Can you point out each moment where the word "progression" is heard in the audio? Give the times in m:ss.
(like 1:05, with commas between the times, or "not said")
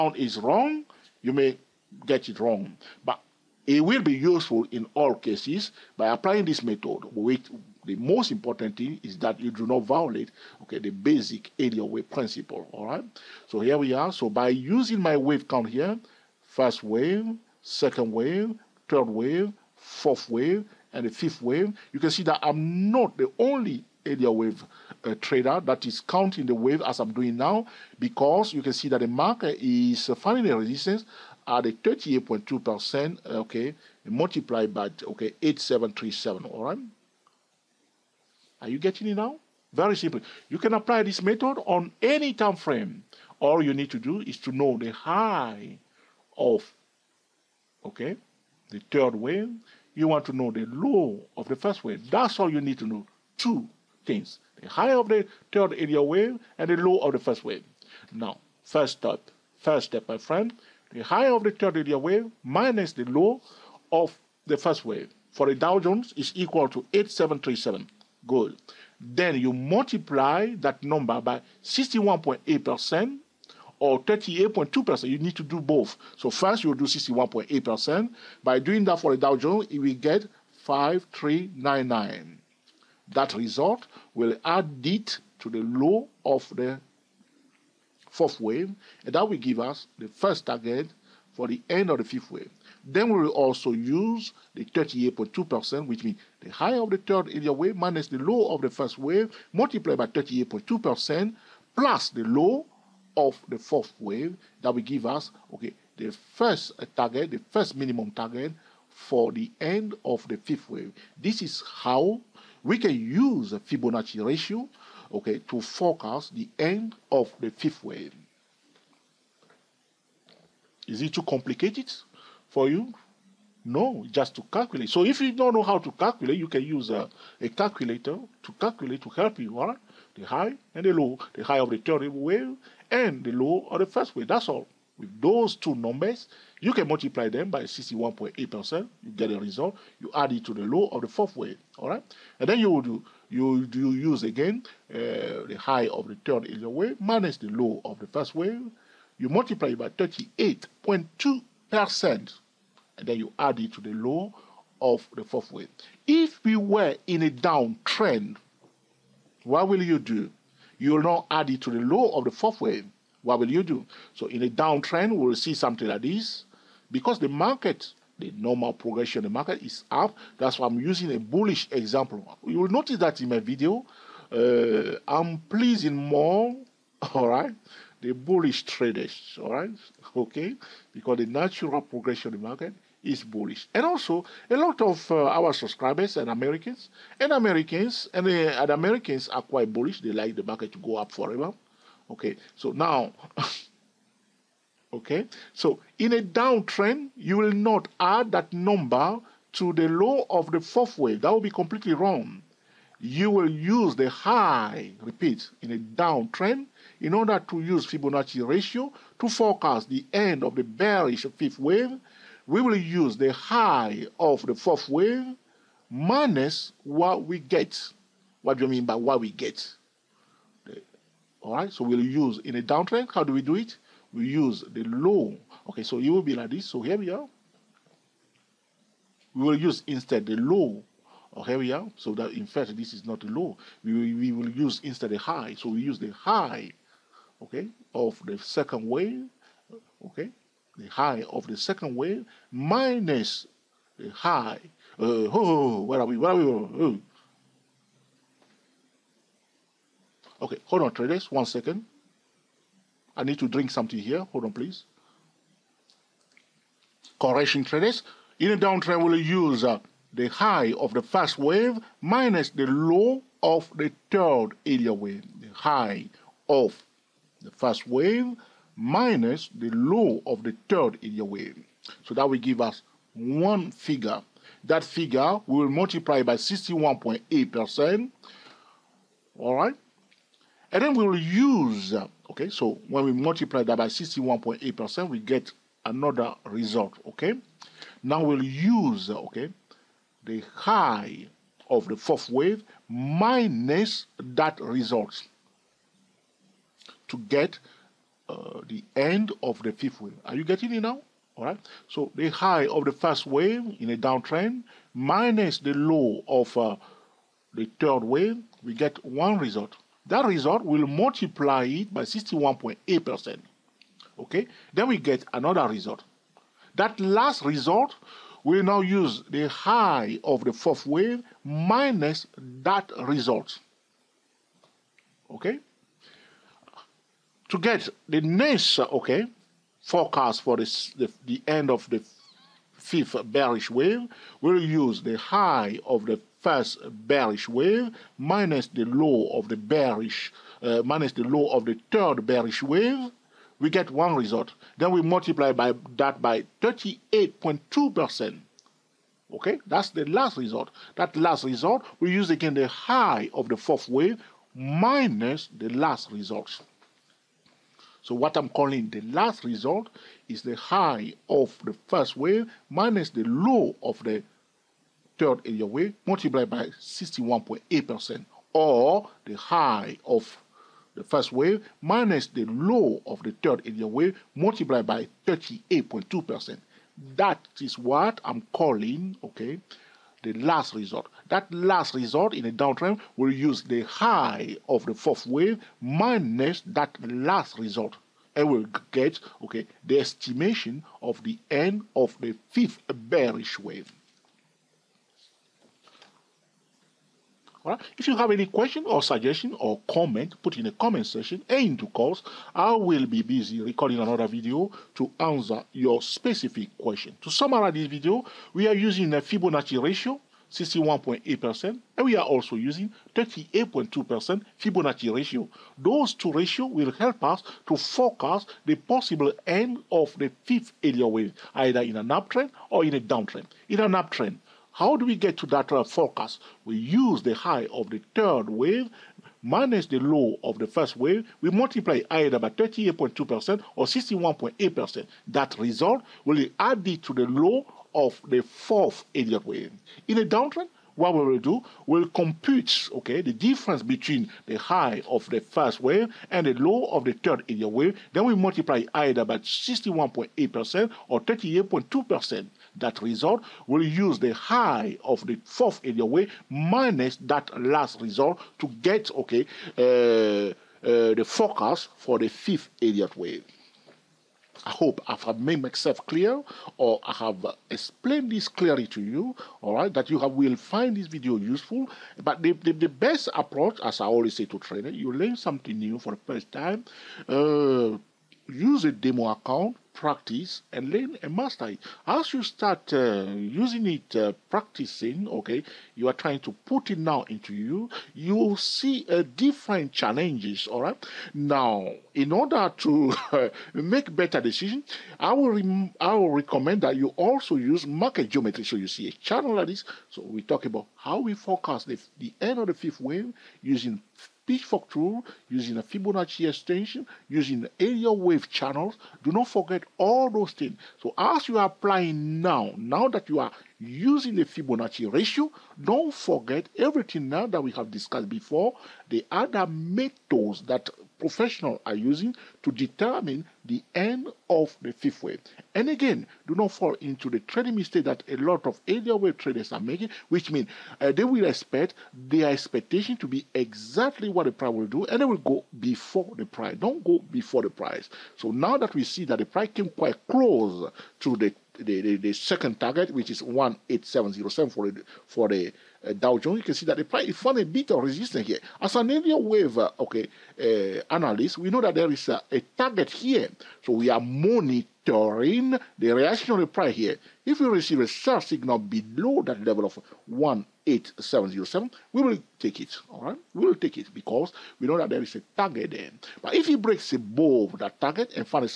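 2:48, 3:01.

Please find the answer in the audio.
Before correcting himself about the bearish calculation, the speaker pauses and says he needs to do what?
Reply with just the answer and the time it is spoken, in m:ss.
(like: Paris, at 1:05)
drink something, at 4:13.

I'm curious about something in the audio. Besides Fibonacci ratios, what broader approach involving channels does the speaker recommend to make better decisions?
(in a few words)
market geometry.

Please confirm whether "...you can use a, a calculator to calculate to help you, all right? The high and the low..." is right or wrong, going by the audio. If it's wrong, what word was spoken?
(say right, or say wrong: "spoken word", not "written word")
right.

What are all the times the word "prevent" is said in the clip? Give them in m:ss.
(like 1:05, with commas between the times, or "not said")
not said.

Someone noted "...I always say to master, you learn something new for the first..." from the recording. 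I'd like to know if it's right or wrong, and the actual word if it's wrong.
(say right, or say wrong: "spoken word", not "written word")
wrong: "trainer", not "master".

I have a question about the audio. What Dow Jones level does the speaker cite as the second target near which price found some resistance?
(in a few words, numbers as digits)
18707.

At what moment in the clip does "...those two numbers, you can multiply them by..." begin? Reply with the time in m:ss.
2:15.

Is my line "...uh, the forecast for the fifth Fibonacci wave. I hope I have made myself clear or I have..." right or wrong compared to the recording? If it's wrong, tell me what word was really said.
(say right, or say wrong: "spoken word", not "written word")
wrong: "Elliott", not "Fibonacci".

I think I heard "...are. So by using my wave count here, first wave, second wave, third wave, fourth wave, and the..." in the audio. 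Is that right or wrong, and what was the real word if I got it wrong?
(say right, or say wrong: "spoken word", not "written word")
right.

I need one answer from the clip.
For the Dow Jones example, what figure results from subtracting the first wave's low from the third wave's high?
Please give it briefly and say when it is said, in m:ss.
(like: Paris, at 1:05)
8737, at 1:05.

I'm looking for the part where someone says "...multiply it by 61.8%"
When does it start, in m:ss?
5:10.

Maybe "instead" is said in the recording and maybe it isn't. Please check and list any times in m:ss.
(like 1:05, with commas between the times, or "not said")
3:49, 3:54.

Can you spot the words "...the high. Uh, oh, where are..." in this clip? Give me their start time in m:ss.
4:03.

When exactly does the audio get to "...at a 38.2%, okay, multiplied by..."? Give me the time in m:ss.
0:31.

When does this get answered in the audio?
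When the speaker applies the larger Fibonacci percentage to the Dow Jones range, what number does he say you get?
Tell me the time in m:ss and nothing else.
1:19.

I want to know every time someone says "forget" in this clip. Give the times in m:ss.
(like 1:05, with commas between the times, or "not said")
8:29, 8:36.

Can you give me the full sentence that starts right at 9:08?
As an Elliott wave, uh, okay, uh, analyst, we know that there is a, a, target here.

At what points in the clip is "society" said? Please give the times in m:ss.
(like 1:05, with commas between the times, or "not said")
not said.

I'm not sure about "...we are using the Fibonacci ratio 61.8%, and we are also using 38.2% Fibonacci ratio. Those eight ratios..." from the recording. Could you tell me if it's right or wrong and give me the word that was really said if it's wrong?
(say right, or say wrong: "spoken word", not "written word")
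wrong: "two", not "eight".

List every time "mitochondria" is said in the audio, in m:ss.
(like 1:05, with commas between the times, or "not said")
not said.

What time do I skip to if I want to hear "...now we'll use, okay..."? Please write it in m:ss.
4:48.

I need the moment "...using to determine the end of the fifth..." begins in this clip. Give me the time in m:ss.
8:41.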